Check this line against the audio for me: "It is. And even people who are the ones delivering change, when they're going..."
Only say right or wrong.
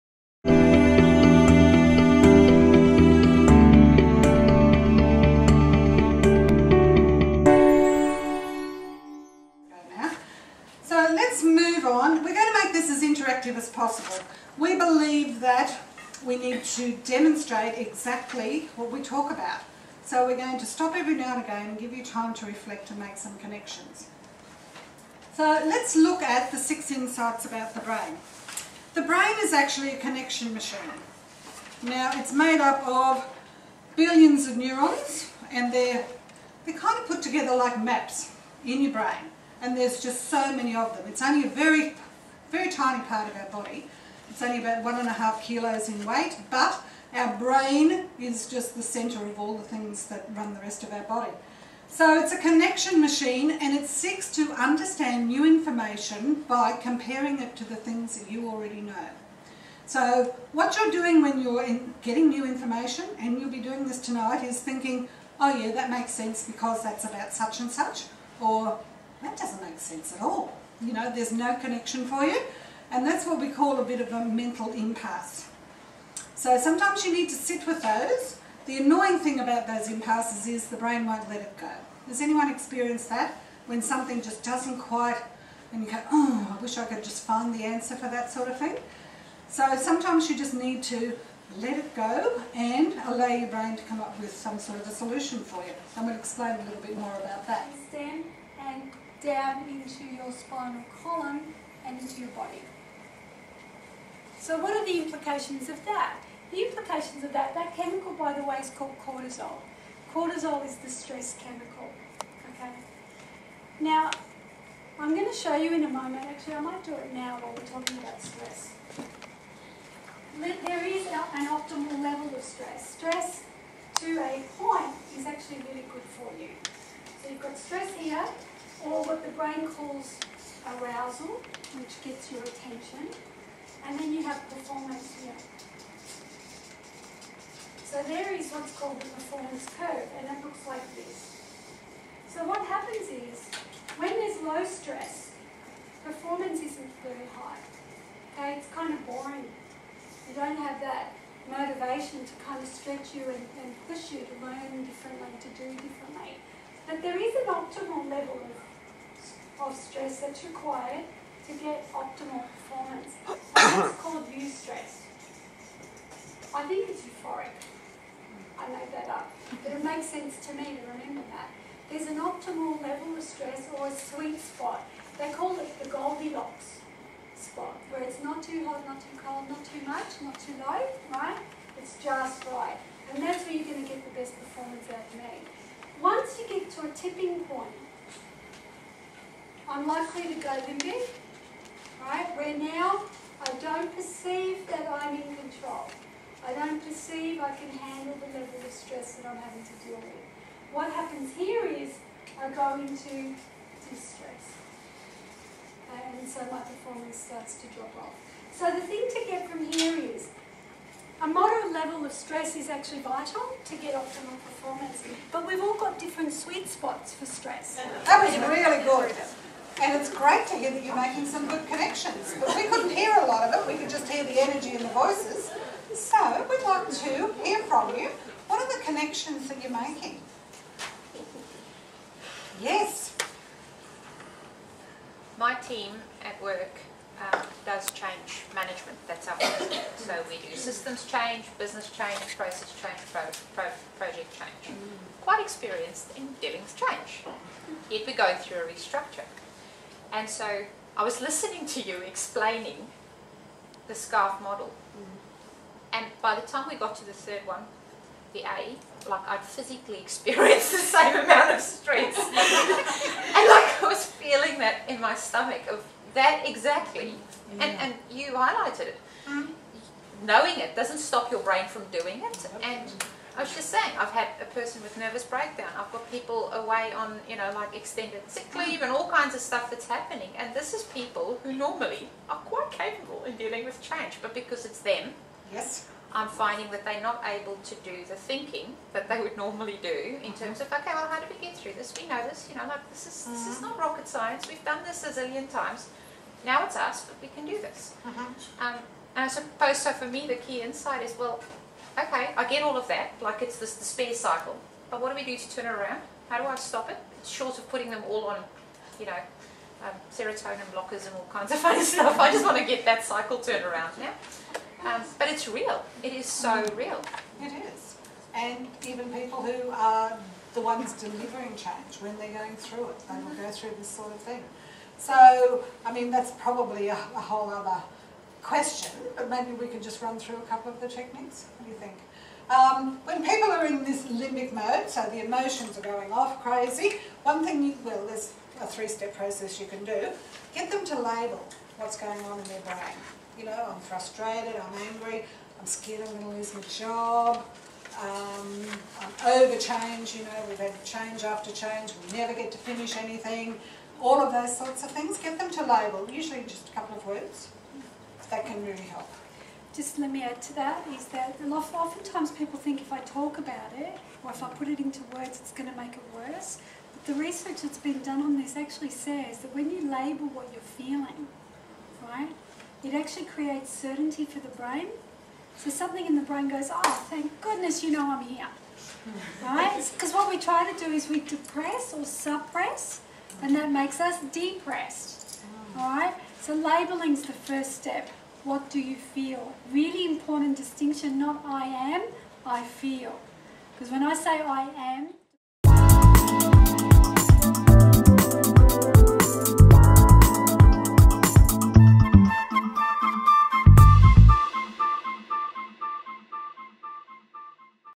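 right.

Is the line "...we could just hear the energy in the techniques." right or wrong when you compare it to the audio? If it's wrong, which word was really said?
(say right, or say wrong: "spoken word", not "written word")
wrong: "voices", not "techniques".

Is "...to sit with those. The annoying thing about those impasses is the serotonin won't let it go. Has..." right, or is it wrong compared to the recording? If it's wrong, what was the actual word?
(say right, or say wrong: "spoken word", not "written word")
wrong: "brain", not "serotonin".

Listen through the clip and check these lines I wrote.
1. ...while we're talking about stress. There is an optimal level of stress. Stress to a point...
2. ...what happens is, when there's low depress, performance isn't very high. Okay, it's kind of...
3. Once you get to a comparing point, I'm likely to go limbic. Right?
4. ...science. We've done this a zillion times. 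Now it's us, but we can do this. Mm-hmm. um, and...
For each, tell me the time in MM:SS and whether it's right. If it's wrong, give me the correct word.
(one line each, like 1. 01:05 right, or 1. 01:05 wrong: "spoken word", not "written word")
1. 01:57 right
2. 02:22 wrong: "stress", not "depress"
3. 03:06 wrong: "tipping", not "comparing"
4. 04:54 right.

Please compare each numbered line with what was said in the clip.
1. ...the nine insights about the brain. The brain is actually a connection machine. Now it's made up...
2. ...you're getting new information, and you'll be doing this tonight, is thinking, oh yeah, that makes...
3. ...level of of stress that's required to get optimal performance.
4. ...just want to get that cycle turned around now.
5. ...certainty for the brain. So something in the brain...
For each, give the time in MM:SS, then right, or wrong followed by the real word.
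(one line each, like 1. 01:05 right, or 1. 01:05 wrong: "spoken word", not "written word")
1. 00:26 wrong: "six", not "nine"
2. 01:01 right
3. 02:38 right
4. 05:12 right
5. 06:13 right.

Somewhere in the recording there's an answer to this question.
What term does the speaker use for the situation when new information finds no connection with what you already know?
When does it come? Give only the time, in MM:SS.
01:14.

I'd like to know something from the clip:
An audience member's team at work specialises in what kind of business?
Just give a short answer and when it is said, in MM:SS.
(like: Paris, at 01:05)
change management, at 03:57.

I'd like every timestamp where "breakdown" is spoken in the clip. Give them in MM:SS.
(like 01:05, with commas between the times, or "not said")
04:35.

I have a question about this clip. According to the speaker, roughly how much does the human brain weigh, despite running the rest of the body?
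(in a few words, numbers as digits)
1.5 kilos.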